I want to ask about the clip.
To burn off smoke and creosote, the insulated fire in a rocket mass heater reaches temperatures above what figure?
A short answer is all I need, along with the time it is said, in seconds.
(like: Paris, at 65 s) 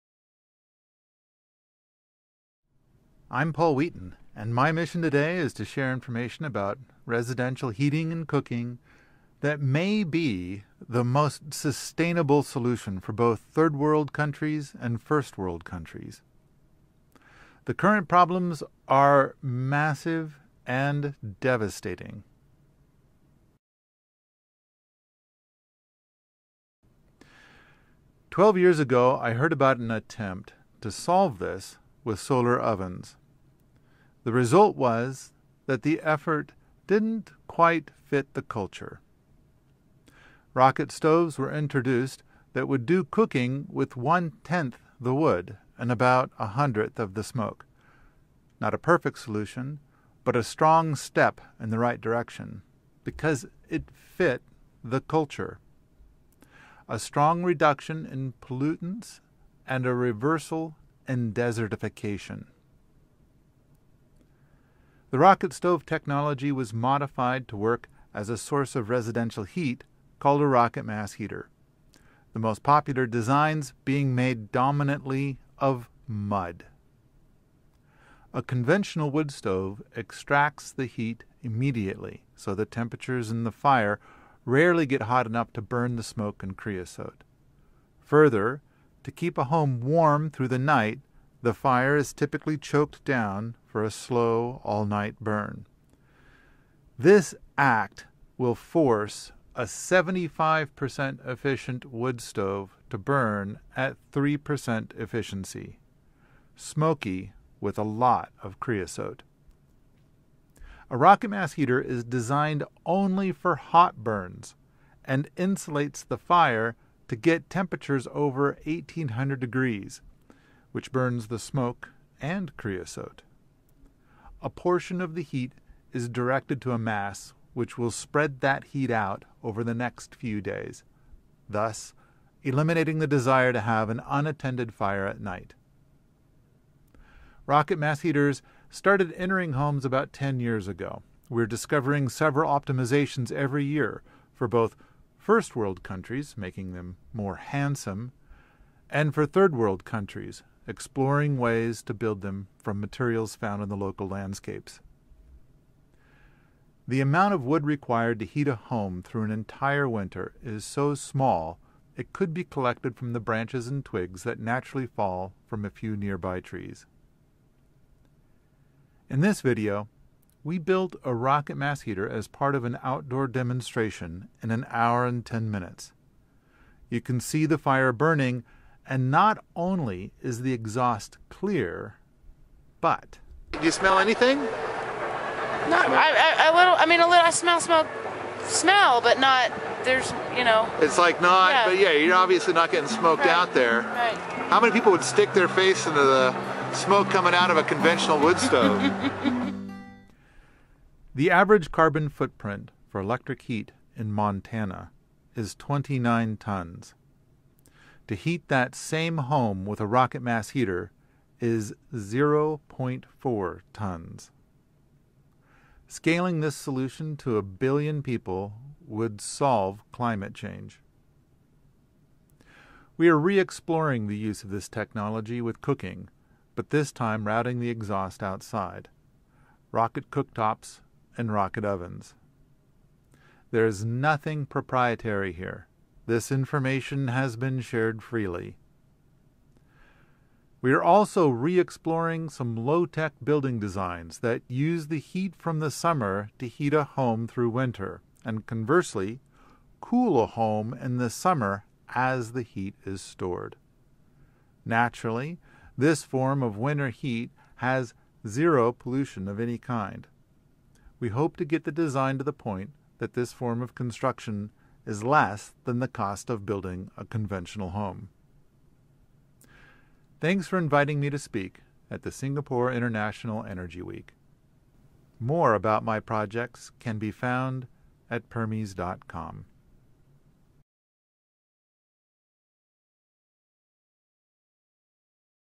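1800 degrees, at 118 s.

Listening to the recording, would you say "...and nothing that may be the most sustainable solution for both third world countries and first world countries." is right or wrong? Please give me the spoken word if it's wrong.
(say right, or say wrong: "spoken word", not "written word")
wrong: "cooking", not "nothing".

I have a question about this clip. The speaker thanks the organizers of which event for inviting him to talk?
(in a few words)
Singapore International Energy Week.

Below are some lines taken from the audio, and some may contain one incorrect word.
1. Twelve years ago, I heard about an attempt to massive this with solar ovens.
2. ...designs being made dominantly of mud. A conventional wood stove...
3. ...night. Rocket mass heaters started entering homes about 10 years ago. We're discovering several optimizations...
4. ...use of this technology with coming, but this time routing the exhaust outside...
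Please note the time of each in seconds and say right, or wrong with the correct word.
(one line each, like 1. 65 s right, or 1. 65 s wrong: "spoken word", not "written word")
1. 28 s wrong: "solve", not "massive"
2. 73 s right
3. 135 s right
4. 224 s wrong: "cooking", not "coming".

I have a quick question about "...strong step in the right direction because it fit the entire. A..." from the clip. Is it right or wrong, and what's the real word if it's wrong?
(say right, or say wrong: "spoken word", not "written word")
wrong: "culture", not "entire".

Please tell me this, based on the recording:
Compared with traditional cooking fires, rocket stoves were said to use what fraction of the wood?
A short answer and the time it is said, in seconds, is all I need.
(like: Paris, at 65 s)
one tenth, at 43 s.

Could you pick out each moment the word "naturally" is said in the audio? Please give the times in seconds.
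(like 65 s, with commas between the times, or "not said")
164 s, 254 s.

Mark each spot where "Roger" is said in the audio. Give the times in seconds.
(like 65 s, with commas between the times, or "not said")
not said.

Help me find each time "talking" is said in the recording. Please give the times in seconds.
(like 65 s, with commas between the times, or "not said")
not said.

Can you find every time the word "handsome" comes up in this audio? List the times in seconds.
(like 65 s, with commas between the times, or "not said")
147 s.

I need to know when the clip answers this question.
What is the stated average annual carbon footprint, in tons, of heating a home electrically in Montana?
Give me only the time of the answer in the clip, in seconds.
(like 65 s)
205 s.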